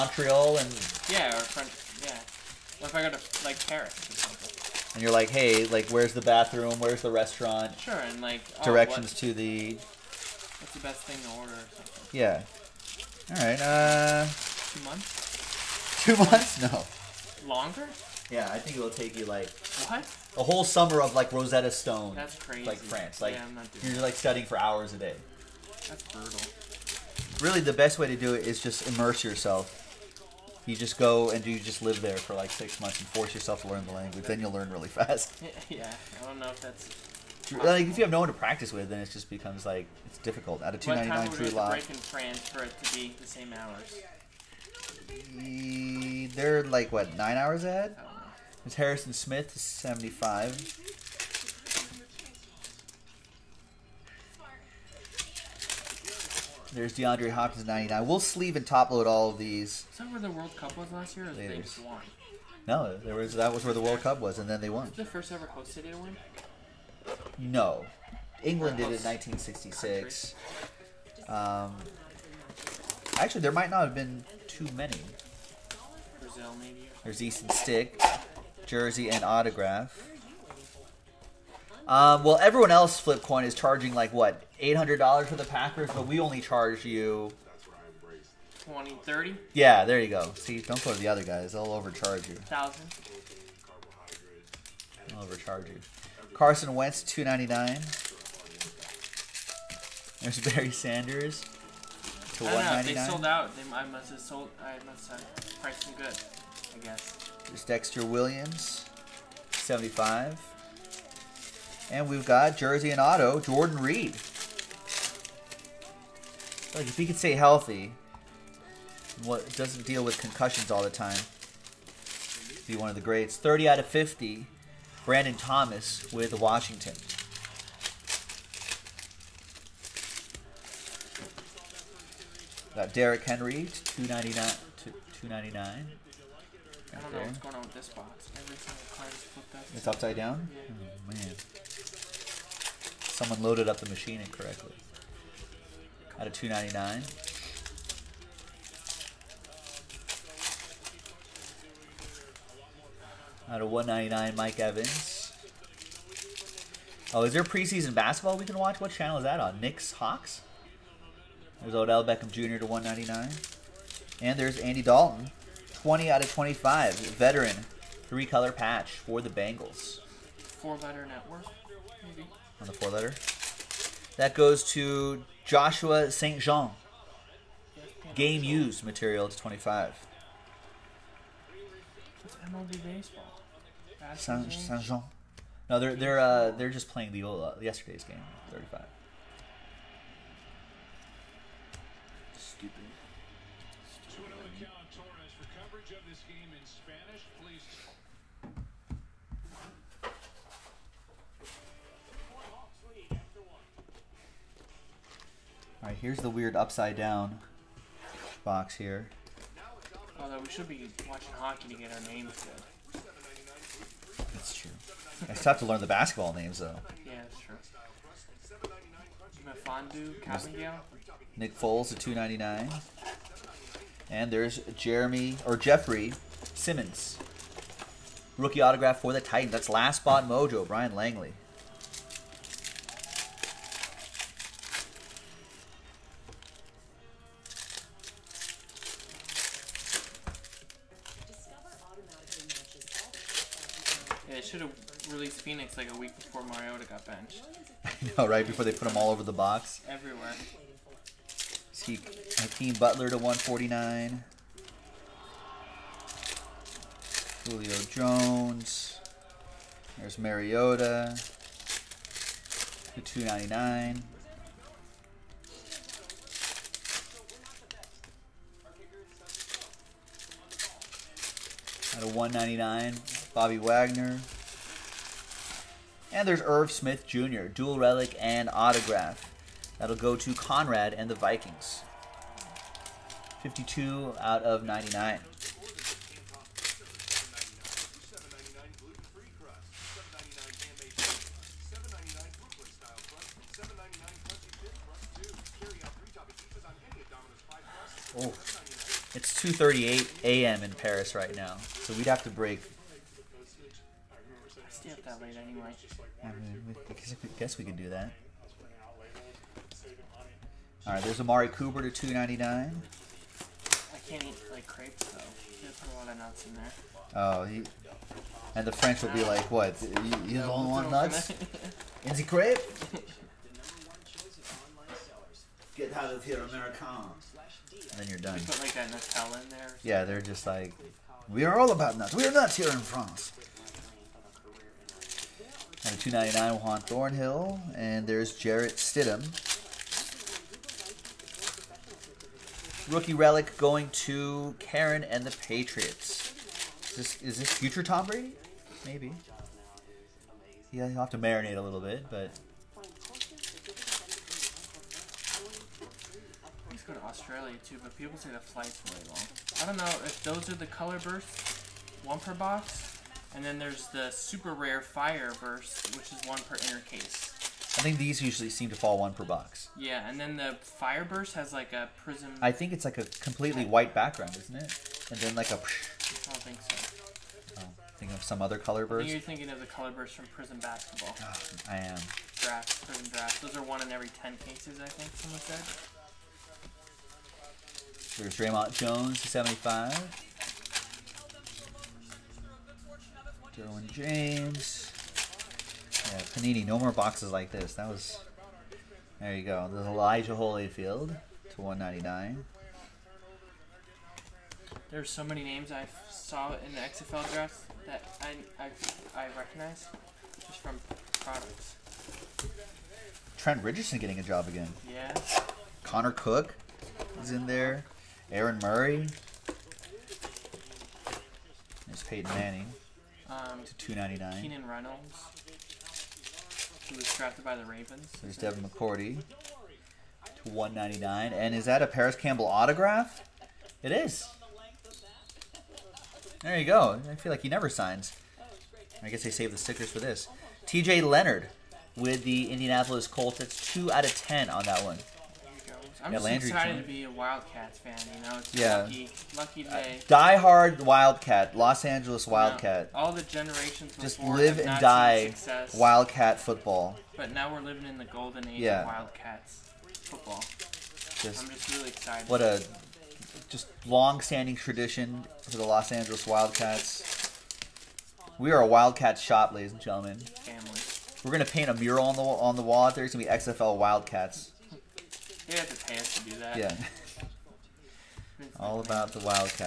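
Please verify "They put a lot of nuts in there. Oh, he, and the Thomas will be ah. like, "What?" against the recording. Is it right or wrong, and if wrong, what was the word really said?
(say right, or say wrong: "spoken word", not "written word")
wrong: "French", not "Thomas".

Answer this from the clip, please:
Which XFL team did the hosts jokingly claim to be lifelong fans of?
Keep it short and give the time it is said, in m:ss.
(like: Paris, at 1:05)
Los Angeles Wildcats, at 7:45.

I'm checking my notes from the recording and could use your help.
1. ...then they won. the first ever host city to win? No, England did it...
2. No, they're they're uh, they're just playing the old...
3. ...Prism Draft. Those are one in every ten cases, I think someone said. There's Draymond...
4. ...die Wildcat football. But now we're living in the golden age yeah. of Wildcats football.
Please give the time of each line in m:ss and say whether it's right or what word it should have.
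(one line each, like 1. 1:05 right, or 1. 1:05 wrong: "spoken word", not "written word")
1. 1:04 right
2. 3:05 right
3. 6:22 right
4. 7:34 right.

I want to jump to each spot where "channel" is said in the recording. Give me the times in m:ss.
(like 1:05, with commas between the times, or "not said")
2:38.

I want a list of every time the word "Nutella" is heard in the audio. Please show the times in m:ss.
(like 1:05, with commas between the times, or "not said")
5:28.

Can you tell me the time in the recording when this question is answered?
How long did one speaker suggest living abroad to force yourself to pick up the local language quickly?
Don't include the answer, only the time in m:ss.
0:32.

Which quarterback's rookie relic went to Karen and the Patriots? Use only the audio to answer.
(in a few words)
Jarrett Stidham.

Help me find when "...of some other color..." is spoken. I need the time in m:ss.
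6:18.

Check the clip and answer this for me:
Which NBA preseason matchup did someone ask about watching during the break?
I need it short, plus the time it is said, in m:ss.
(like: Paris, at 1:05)
Knicks Hawks, at 2:39.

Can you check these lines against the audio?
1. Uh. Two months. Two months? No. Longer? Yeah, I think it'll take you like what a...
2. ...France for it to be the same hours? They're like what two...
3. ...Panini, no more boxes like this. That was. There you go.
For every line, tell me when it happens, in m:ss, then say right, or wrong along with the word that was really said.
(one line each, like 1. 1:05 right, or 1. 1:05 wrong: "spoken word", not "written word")
1. 0:13 right
2. 0:41 wrong: "nine", not "two"
3. 6:36 right.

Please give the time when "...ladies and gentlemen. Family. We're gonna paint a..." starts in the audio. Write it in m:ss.
7:49.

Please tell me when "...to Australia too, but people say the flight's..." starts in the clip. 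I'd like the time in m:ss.
5:56.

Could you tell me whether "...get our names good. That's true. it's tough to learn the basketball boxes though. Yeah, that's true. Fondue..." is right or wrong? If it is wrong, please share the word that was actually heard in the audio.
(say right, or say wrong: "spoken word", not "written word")
wrong: "names", not "boxes".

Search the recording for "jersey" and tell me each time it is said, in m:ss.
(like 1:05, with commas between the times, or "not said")
1:18, 1:52.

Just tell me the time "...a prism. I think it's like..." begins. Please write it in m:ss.
6:11.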